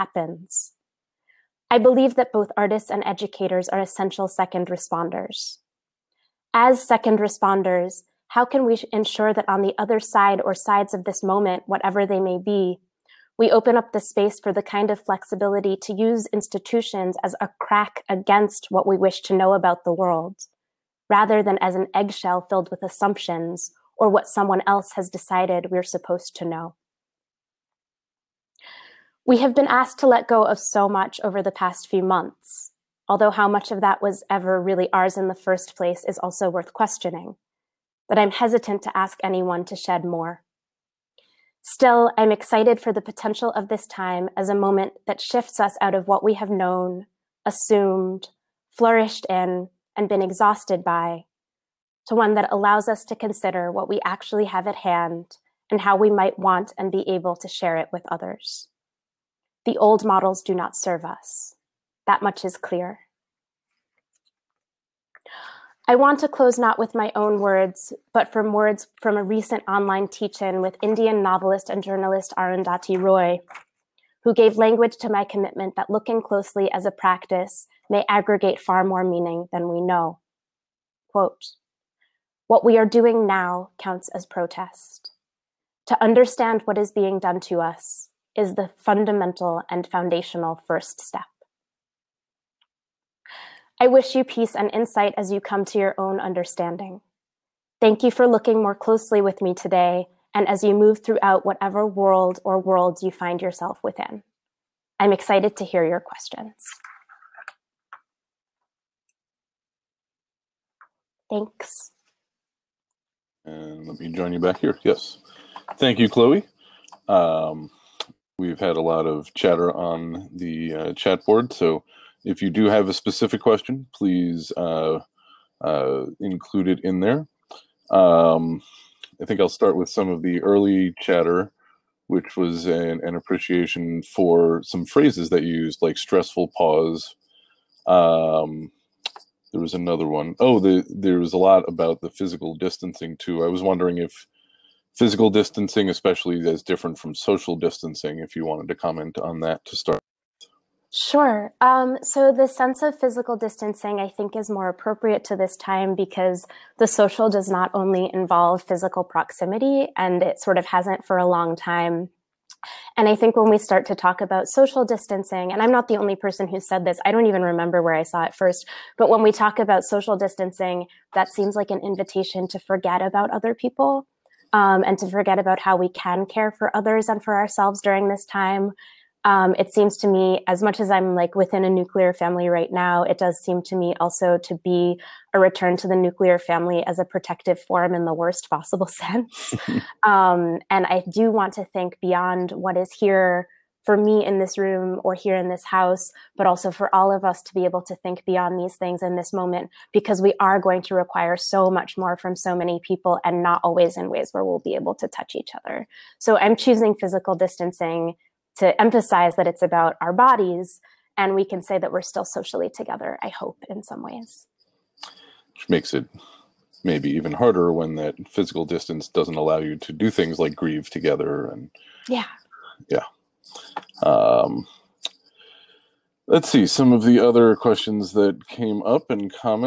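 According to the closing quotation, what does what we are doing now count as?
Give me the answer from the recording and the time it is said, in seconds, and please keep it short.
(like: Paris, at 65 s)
protest, at 84 s.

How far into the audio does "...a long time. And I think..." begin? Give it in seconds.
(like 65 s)
161 s.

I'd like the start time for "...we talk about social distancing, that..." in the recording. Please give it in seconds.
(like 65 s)
169 s.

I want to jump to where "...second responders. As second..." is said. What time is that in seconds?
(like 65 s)
4 s.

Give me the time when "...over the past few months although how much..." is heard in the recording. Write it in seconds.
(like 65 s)
31 s.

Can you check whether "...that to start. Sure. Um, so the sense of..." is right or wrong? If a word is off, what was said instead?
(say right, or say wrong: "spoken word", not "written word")
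right.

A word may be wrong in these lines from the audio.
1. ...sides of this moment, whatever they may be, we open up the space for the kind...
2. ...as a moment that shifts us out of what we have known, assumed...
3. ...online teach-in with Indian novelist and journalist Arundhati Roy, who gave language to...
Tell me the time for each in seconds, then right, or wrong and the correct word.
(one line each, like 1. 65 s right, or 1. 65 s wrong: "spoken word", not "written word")
1. 10 s right
2. 44 s right
3. 69 s right.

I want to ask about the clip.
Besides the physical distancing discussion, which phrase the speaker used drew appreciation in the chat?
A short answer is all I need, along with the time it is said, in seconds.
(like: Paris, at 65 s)
stressful pause, at 135 s.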